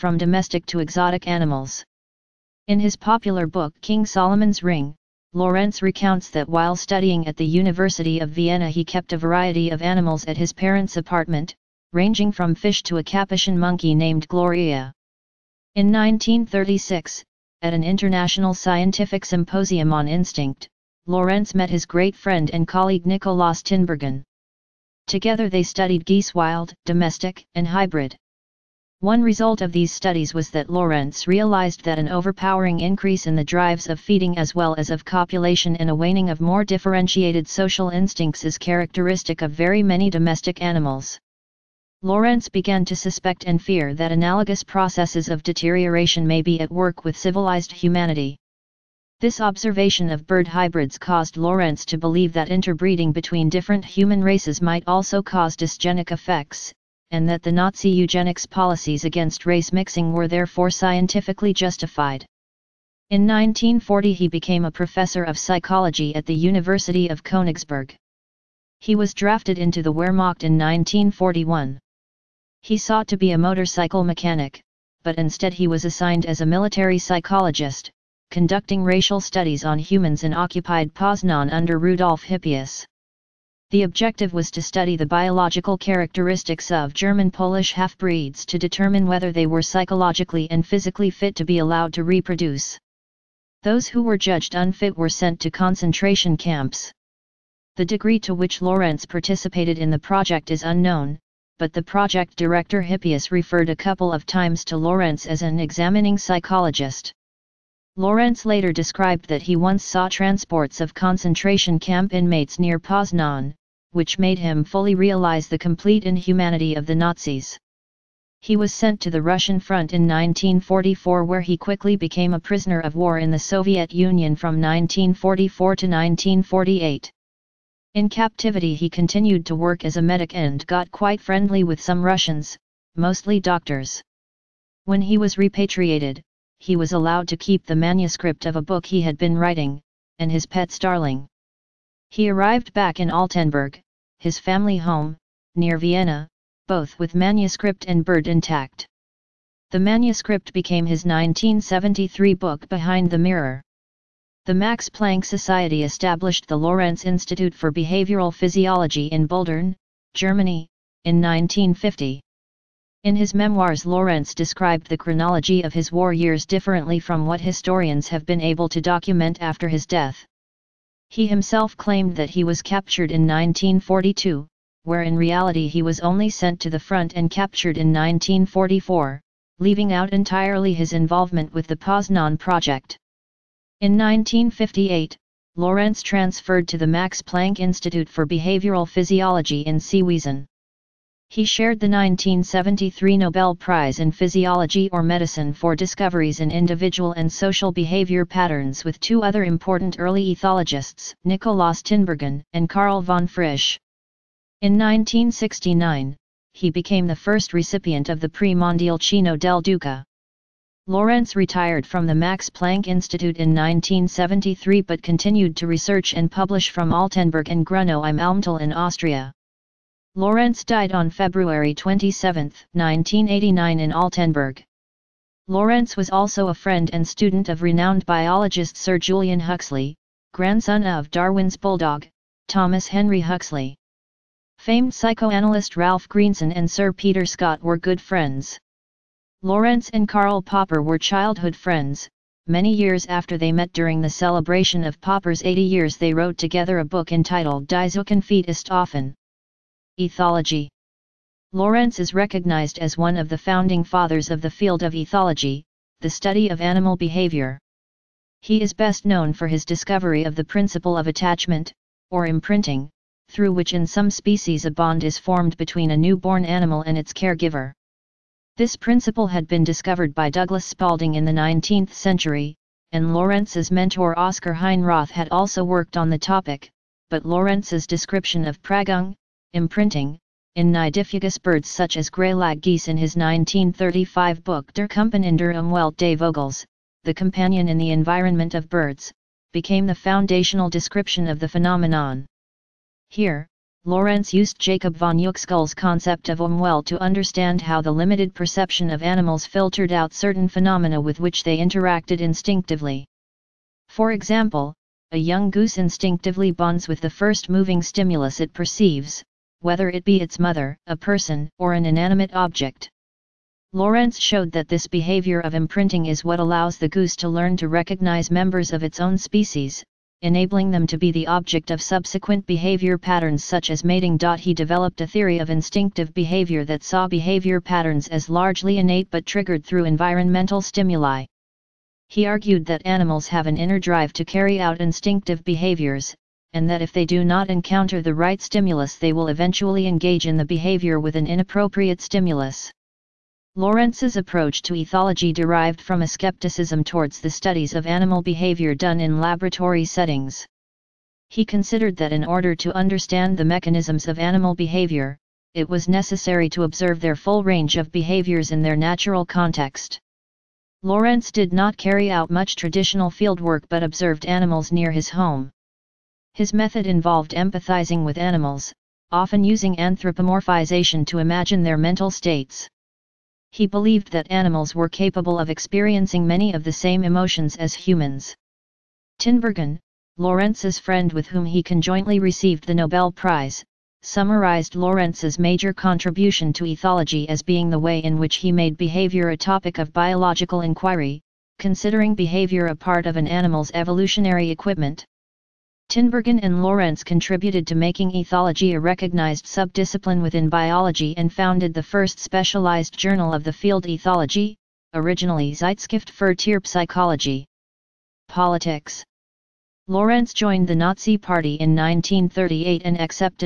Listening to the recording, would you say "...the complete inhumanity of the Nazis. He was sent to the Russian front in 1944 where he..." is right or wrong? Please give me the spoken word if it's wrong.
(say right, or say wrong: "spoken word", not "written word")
right.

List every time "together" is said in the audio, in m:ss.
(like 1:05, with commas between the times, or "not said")
0:25, 4:06.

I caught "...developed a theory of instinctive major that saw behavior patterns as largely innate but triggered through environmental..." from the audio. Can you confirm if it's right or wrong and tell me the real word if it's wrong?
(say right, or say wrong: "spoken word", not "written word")
wrong: "behavior", not "major".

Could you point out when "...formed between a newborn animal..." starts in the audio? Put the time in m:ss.
4:25.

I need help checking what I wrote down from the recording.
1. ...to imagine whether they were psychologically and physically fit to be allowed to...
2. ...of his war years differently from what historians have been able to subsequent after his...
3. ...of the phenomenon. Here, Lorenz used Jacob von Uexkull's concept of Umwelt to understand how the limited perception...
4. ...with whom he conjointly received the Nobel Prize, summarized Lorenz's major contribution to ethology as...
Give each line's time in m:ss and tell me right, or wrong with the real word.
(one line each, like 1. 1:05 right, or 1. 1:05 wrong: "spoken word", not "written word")
1. 1:28 wrong: "determine", not "imagine"
2. 2:45 wrong: "document", not "subsequent"
3. 4:51 right
4. 6:21 right.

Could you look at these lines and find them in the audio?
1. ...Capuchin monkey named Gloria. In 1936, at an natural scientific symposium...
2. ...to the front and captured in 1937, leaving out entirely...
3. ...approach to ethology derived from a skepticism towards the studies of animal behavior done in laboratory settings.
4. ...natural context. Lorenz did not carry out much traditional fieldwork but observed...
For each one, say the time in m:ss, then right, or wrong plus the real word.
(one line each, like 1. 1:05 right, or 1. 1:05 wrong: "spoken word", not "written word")
1. 0:13 wrong: "international", not "natural"
2. 2:56 wrong: "1944", not "1937"
3. 5:44 right
4. 5:58 right.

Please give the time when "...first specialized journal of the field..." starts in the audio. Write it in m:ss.
6:41.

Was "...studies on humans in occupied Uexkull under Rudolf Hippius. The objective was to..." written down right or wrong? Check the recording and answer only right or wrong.
wrong.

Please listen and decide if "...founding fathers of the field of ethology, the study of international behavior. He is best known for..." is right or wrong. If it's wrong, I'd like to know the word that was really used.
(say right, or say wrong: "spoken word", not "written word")
wrong: "animal", not "international".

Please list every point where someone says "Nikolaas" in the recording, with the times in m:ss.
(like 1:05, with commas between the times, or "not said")
0:23, 3:21.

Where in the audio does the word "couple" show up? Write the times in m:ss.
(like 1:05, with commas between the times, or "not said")
1:43.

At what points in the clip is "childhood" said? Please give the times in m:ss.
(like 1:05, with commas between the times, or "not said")
4:00.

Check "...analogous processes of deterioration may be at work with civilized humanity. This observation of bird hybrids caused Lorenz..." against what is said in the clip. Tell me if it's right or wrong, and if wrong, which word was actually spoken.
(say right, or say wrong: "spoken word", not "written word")
right.